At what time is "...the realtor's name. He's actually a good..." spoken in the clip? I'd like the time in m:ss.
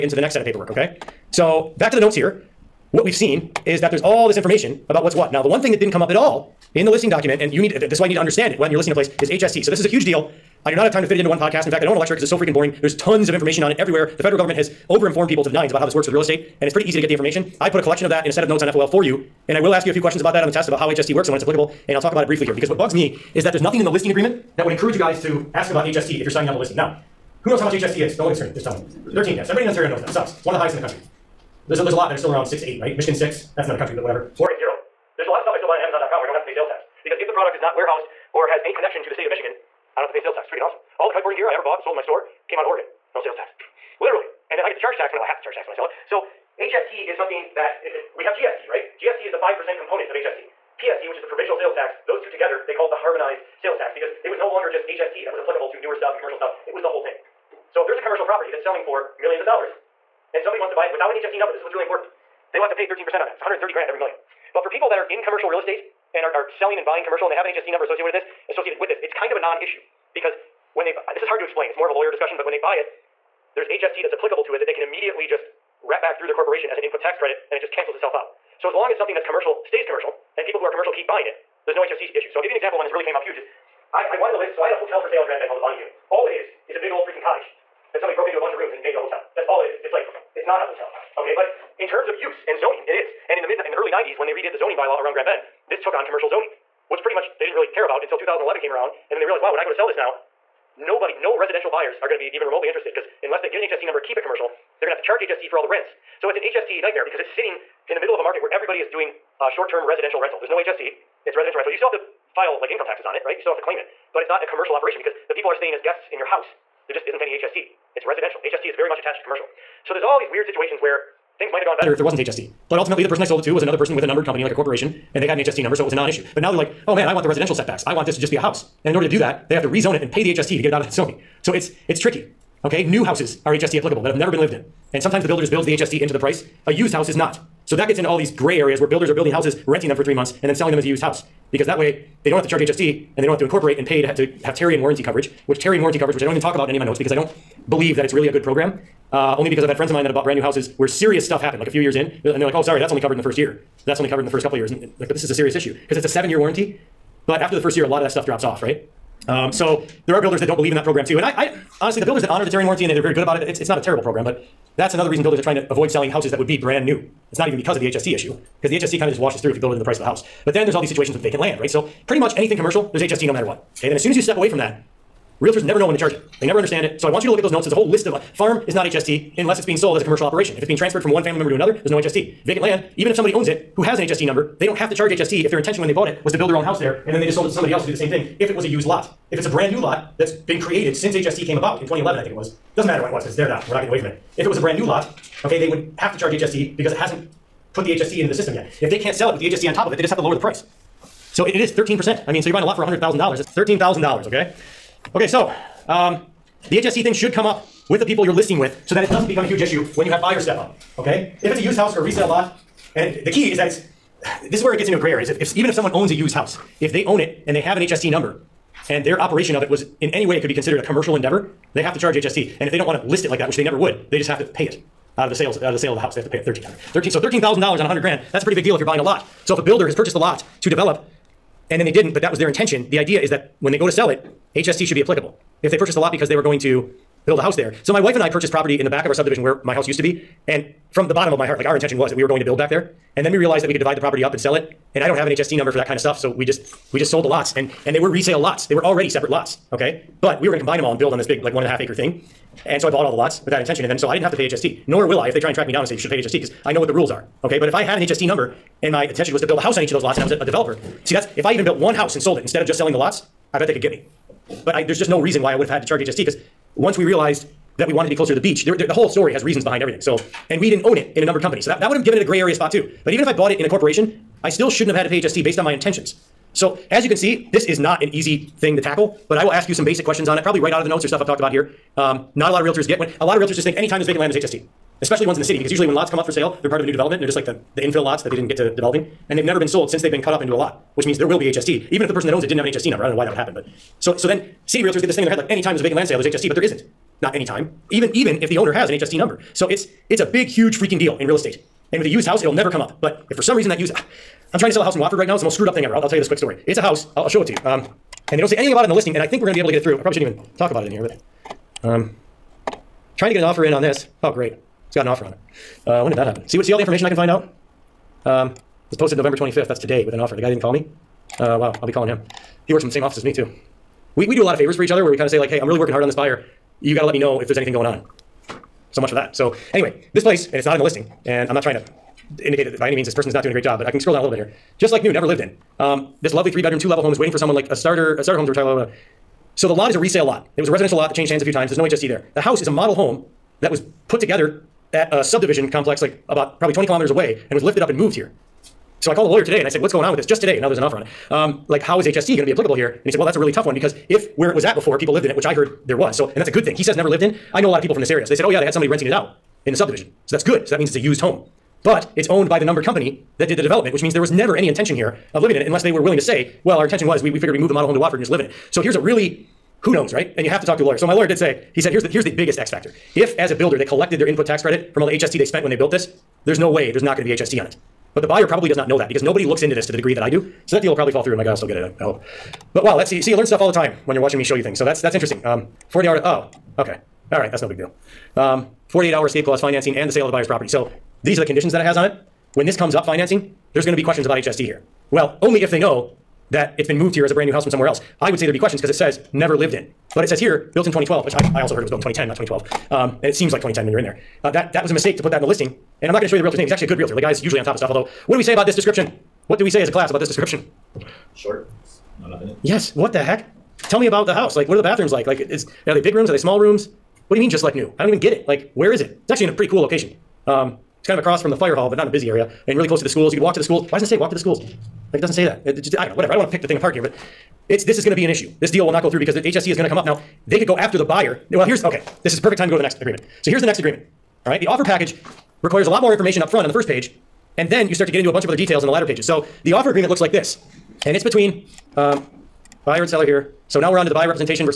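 6:46.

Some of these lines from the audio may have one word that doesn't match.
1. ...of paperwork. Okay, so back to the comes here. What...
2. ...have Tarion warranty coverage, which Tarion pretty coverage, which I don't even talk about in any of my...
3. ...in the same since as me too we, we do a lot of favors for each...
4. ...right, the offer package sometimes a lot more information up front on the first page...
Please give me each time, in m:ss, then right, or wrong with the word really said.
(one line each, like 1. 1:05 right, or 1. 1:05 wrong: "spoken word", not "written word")
1. 0:00 wrong: "notes", not "comes"
2. 2:24 wrong: "warranty", not "pretty"
3. 5:22 wrong: "office", not "since"
4. 7:14 wrong: "requires", not "sometimes".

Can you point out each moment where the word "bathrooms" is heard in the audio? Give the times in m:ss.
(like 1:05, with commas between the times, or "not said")
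6:54.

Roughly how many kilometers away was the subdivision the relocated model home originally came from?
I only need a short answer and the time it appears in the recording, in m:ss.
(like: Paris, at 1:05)
20 kilometers, at 5:46.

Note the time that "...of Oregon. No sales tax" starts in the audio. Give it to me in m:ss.
0:42.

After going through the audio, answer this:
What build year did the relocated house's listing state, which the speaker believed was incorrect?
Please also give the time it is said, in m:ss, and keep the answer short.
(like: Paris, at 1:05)
2012, at 6:40.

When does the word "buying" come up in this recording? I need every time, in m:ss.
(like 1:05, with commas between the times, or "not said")
1:06, 1:21, 3:22, 3:48.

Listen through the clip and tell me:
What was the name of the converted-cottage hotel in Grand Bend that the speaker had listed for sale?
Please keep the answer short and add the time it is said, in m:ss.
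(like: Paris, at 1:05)
Bonnie Dune, at 1:25.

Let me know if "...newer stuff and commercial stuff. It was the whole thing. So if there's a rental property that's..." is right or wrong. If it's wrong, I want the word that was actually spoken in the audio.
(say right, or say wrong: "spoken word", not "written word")
wrong: "commercial", not "rental".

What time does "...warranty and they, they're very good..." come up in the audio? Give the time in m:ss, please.
2:42.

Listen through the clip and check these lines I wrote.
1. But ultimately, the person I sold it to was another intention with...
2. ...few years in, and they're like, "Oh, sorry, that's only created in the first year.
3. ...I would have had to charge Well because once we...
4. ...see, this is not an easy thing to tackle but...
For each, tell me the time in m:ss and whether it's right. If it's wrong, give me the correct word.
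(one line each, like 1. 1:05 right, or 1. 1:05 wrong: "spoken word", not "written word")
1. 2:02 wrong: "person", not "intention"
2. 2:31 wrong: "covered", not "created"
3. 4:25 wrong: "HST", not "Well"
4. 4:37 right.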